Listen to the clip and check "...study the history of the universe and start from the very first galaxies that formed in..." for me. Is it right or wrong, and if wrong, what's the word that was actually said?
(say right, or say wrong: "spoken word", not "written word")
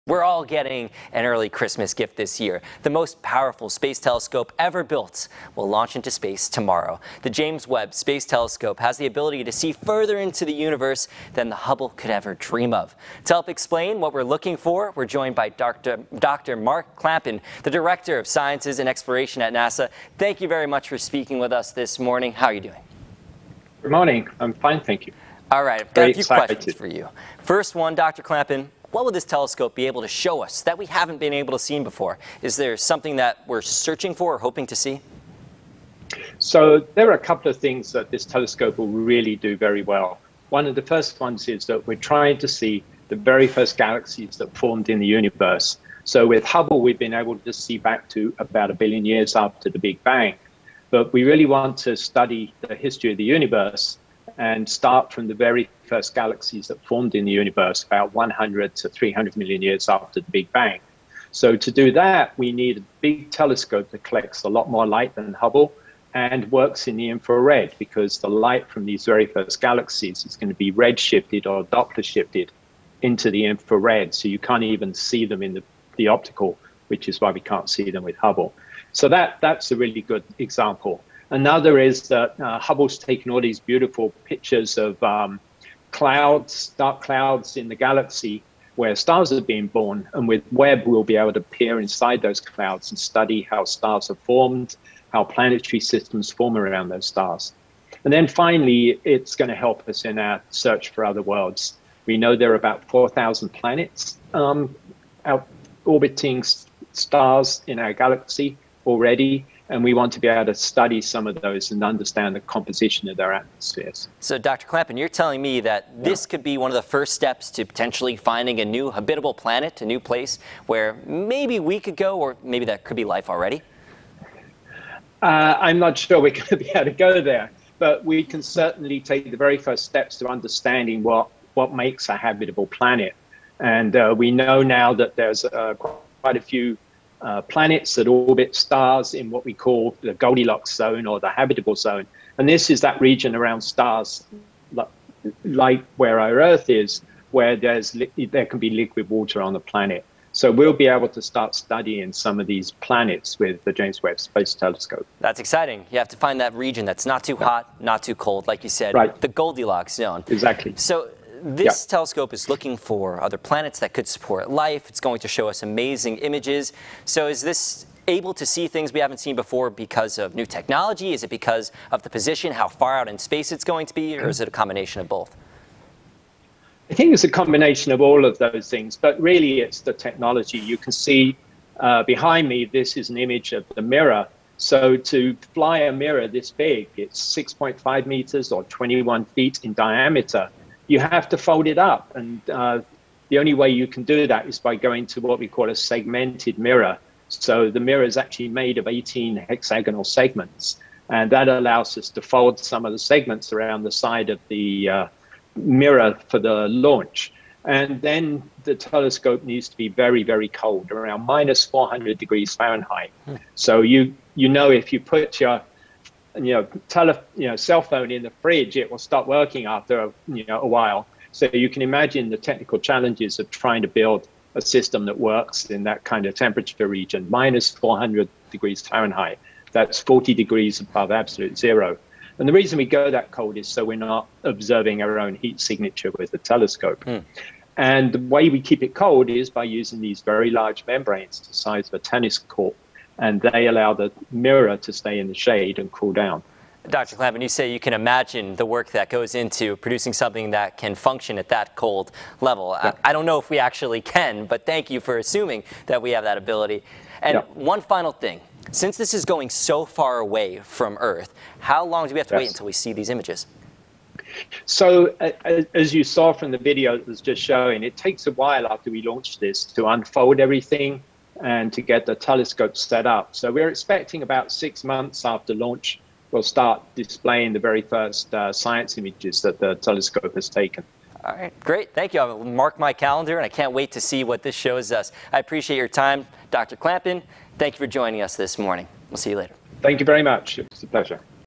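right.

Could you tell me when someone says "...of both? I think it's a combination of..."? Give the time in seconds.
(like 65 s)
175 s.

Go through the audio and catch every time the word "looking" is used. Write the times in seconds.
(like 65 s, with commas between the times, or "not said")
14 s, 162 s.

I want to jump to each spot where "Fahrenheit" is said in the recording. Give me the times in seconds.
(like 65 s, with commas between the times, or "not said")
212 s, 228 s.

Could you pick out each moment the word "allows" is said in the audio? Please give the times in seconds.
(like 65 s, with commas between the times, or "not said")
201 s, 243 s.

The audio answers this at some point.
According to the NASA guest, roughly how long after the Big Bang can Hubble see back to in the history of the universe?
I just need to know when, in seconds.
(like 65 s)
48 s.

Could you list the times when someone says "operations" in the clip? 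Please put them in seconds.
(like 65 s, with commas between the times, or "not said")
not said.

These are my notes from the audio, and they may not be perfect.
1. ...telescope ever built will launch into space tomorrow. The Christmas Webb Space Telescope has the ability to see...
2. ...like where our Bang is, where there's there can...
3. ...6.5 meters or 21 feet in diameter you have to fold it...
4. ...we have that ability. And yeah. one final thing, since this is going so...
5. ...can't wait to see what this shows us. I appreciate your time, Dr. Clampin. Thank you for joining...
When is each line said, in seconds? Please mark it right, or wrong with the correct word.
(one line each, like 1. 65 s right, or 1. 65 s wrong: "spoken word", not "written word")
1. 3 s wrong: "James", not "Christmas"
2. 145 s wrong: "Earth", not "Bang"
3. 187 s right
4. 256 s right
5. 283 s right.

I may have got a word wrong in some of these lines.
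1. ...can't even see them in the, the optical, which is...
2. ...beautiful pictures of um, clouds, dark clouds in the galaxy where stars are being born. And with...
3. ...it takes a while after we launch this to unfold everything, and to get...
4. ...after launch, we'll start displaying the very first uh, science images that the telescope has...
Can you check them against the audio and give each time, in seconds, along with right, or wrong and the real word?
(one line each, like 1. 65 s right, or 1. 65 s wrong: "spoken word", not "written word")
1. 74 s right
2. 83 s right
3. 267 s right
4. 275 s right.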